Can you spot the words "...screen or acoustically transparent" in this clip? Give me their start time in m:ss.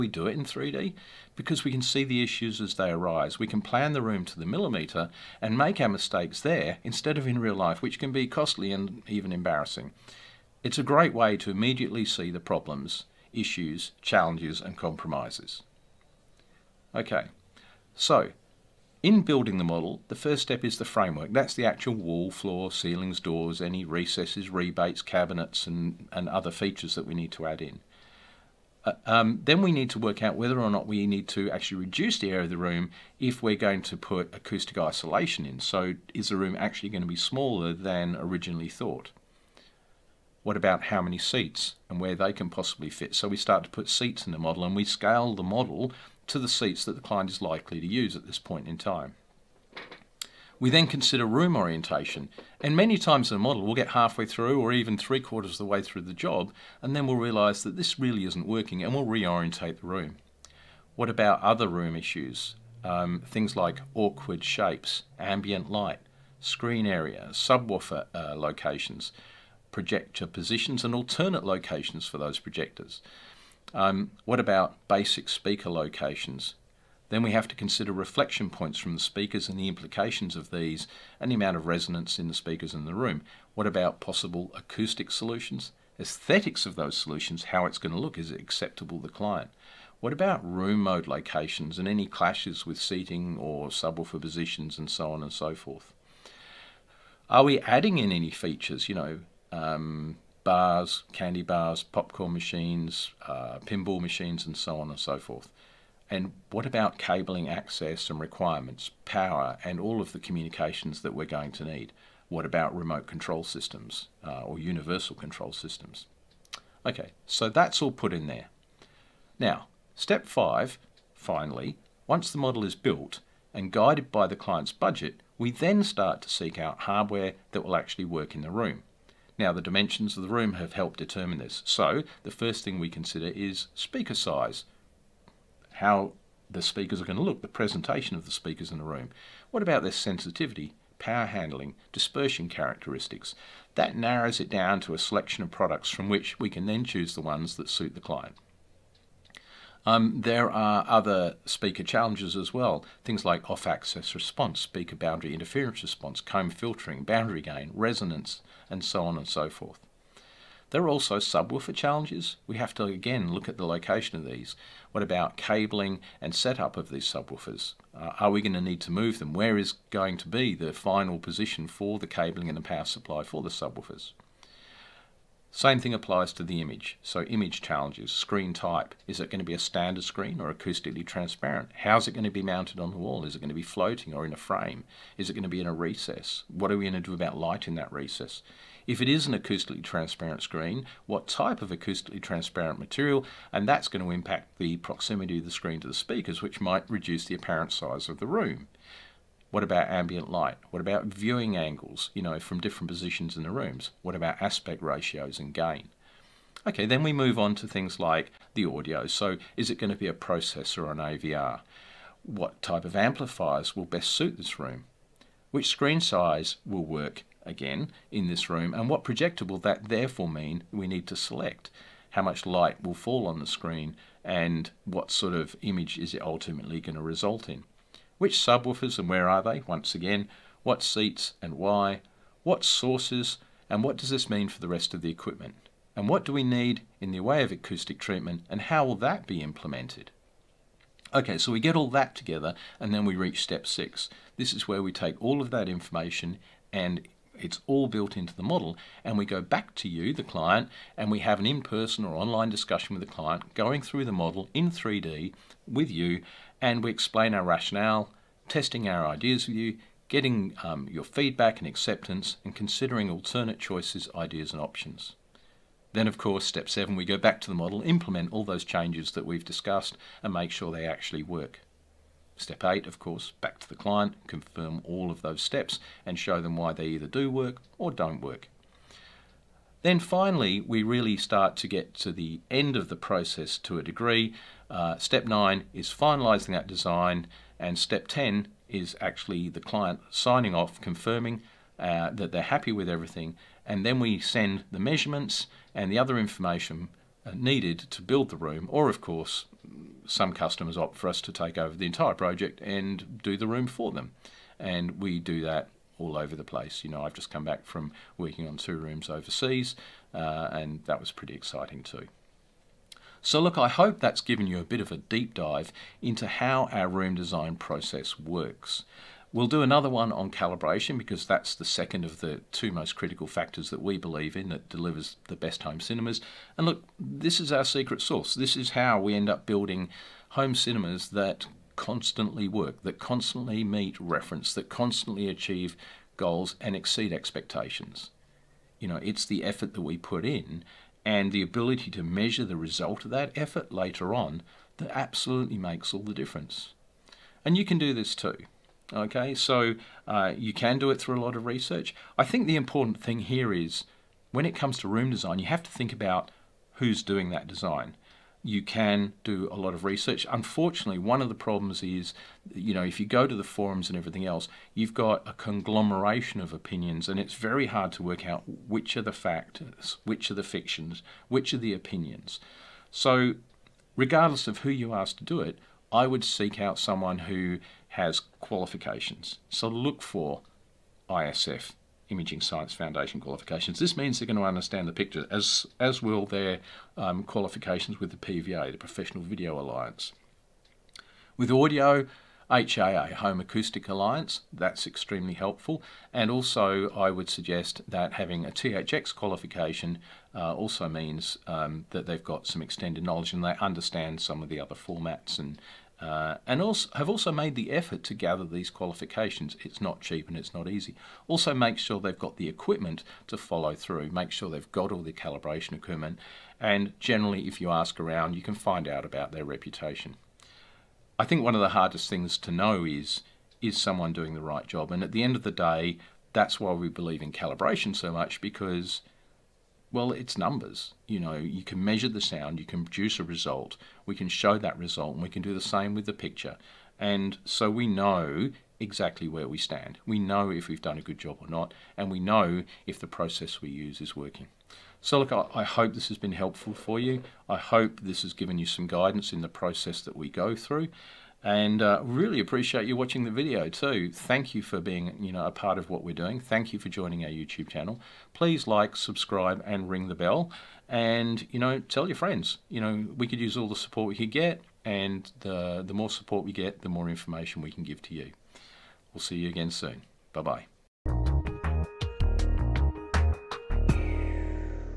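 3:00.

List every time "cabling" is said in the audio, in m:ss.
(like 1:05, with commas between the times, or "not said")
1:46, 2:45, 2:52.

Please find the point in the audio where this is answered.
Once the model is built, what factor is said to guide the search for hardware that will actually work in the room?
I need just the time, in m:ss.
2:04.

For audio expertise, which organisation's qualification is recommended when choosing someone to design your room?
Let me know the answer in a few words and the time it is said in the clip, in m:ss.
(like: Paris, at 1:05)
Home Acoustic Alliance, at 6:33.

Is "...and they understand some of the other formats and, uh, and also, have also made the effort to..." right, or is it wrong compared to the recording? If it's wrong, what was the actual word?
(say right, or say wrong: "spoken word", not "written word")
right.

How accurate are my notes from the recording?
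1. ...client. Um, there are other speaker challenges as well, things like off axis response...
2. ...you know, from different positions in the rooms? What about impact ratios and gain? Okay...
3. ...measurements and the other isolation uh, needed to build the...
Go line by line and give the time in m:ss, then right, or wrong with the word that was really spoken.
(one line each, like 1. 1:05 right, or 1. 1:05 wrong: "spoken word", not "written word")
1. 2:28 right
2. 3:22 wrong: "aspect", not "impact"
3. 4:54 wrong: "information", not "isolation".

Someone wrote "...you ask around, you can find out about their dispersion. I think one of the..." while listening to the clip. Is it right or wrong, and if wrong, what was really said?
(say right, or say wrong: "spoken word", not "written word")
wrong: "reputation", not "dispersion".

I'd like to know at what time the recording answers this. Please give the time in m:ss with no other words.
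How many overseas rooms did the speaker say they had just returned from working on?
5:08.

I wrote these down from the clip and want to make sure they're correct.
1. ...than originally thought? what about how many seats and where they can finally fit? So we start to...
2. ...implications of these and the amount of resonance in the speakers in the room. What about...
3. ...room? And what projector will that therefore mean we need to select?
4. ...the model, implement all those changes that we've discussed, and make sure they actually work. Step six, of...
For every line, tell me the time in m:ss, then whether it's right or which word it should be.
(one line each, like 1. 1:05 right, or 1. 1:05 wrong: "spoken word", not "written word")
1. 0:37 wrong: "possibly", not "finally"
2. 1:19 right
3. 3:38 right
4. 4:27 wrong: "eight", not "six".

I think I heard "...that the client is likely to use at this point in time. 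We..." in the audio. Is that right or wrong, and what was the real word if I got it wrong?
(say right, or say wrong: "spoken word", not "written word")
right.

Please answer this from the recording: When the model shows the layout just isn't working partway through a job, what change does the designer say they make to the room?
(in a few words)
Reorientate the room.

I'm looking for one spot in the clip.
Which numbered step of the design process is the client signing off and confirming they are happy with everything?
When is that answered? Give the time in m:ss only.
4:47.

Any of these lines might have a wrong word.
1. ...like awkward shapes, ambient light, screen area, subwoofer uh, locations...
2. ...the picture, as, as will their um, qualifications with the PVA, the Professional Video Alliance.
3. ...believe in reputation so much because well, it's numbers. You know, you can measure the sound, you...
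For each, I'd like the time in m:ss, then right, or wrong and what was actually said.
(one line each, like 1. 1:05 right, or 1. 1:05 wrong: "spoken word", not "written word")
1. 1:03 right
2. 6:24 right
3. 7:06 wrong: "calibration", not "reputation".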